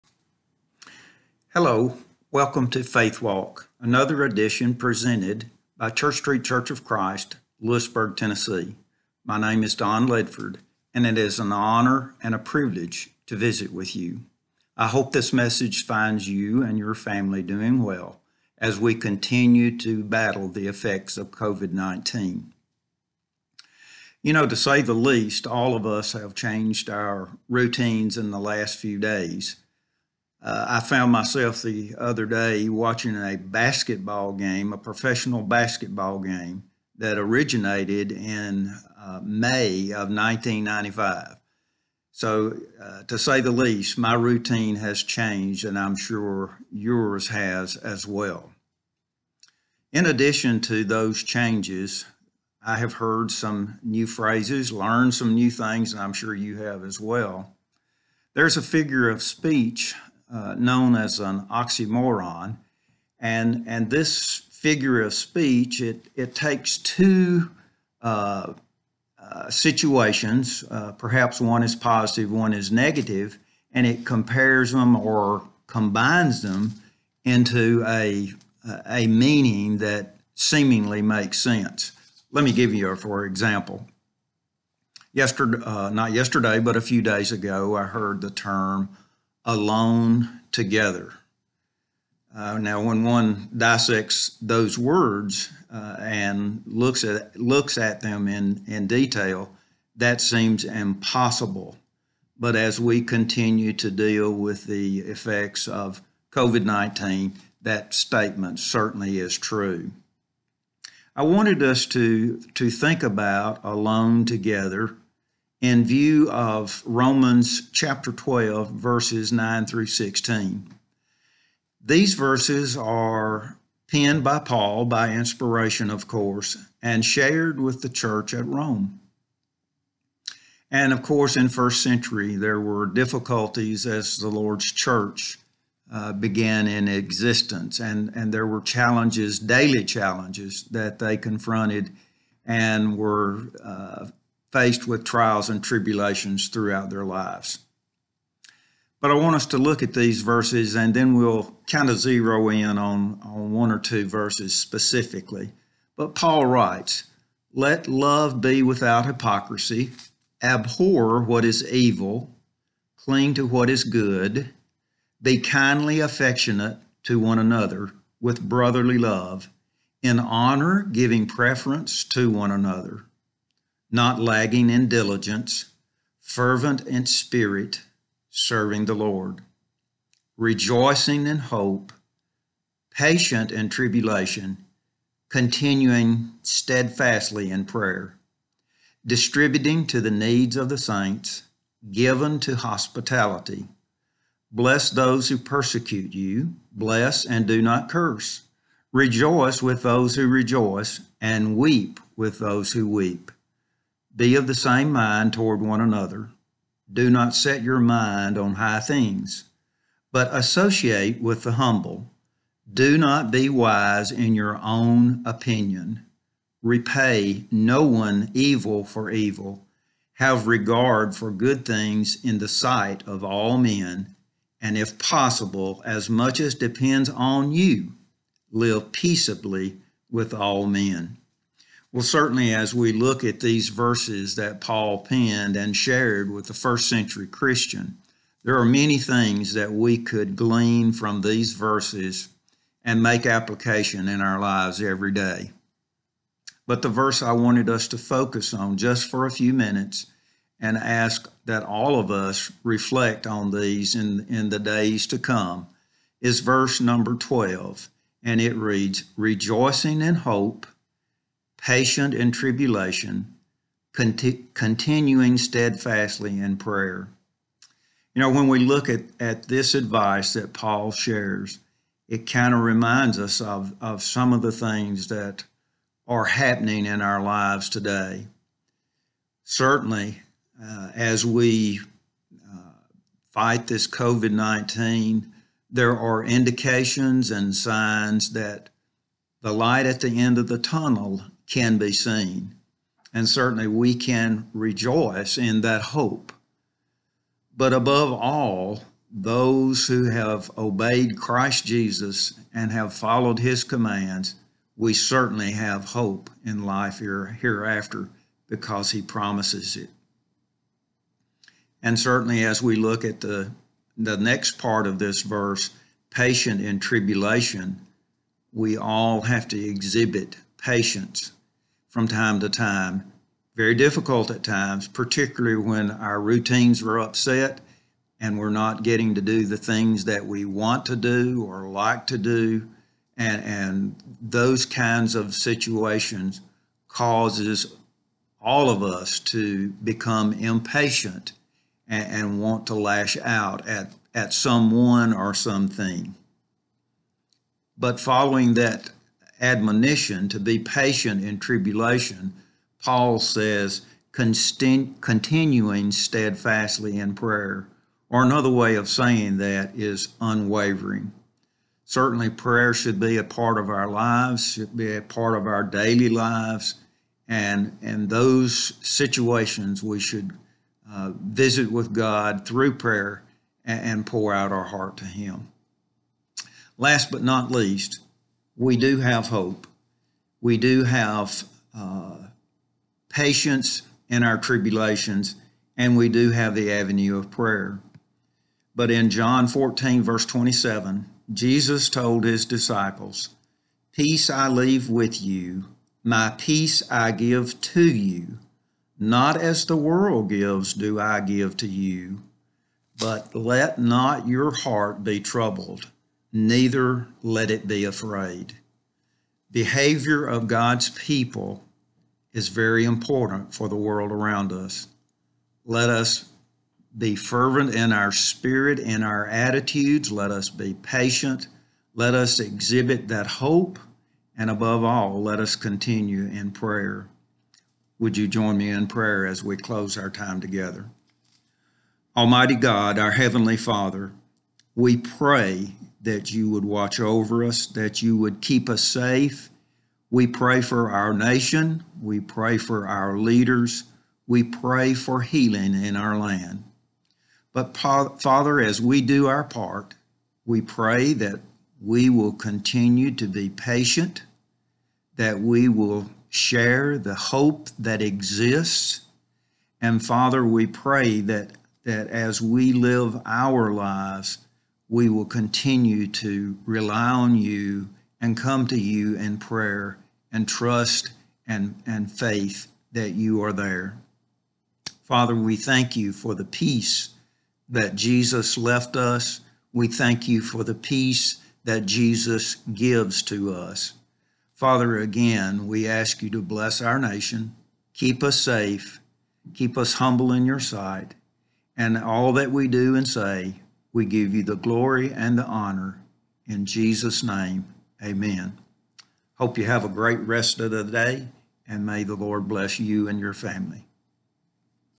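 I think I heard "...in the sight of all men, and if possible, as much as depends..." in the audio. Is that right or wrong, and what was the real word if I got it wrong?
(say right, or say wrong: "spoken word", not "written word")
right.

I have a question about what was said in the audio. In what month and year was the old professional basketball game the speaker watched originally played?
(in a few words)
May 1995.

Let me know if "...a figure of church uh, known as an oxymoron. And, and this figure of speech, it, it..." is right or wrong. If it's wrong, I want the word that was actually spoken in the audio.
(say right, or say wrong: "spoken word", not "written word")
wrong: "speech", not "church".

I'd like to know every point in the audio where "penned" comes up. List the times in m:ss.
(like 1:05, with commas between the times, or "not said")
2:03, 3:54.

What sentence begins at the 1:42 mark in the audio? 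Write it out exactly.
But as we continue to deal with the effects of COVID 19, that statement certainly is true.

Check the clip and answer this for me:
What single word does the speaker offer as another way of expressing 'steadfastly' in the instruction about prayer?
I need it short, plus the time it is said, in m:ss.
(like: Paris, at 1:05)
Unwavering, at 6:00.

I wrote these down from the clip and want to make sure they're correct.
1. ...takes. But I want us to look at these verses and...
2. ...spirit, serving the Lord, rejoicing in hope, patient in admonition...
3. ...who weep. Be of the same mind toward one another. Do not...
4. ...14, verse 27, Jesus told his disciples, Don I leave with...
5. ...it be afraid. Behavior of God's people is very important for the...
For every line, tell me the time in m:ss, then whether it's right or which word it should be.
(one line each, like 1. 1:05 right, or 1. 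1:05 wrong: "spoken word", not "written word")
1. 2:27 wrong: "lives", not "takes"
2. 2:57 wrong: "tribulation", not "admonition"
3. 3:22 right
4. 6:29 wrong: "Peace", not "Don"
5. 6:47 right.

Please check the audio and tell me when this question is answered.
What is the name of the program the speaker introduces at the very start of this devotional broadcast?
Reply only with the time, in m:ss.
0:02.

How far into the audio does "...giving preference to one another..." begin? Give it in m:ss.
2:50.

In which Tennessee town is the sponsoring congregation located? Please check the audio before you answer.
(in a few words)
Lewisburg.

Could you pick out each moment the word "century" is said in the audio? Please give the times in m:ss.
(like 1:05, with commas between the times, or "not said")
2:11, 3:56.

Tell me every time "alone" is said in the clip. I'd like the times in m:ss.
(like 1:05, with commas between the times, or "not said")
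1:29, 1:53.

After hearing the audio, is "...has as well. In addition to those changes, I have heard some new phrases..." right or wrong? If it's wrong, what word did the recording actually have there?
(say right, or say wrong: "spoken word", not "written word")
right.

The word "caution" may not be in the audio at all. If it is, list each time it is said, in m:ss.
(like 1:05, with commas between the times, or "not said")
not said.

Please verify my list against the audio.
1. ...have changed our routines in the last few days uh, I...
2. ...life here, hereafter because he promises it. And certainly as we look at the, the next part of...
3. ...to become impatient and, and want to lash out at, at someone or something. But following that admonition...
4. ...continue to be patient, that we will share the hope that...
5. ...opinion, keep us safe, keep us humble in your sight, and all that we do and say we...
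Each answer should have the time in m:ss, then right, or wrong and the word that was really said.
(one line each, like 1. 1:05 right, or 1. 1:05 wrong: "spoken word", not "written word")
1. 0:26 right
2. 5:06 right
3. 5:39 right
4. 7:32 right
5. 8:06 wrong: "nation", not "opinion".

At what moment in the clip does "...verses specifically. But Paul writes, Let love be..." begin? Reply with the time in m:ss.
2:34.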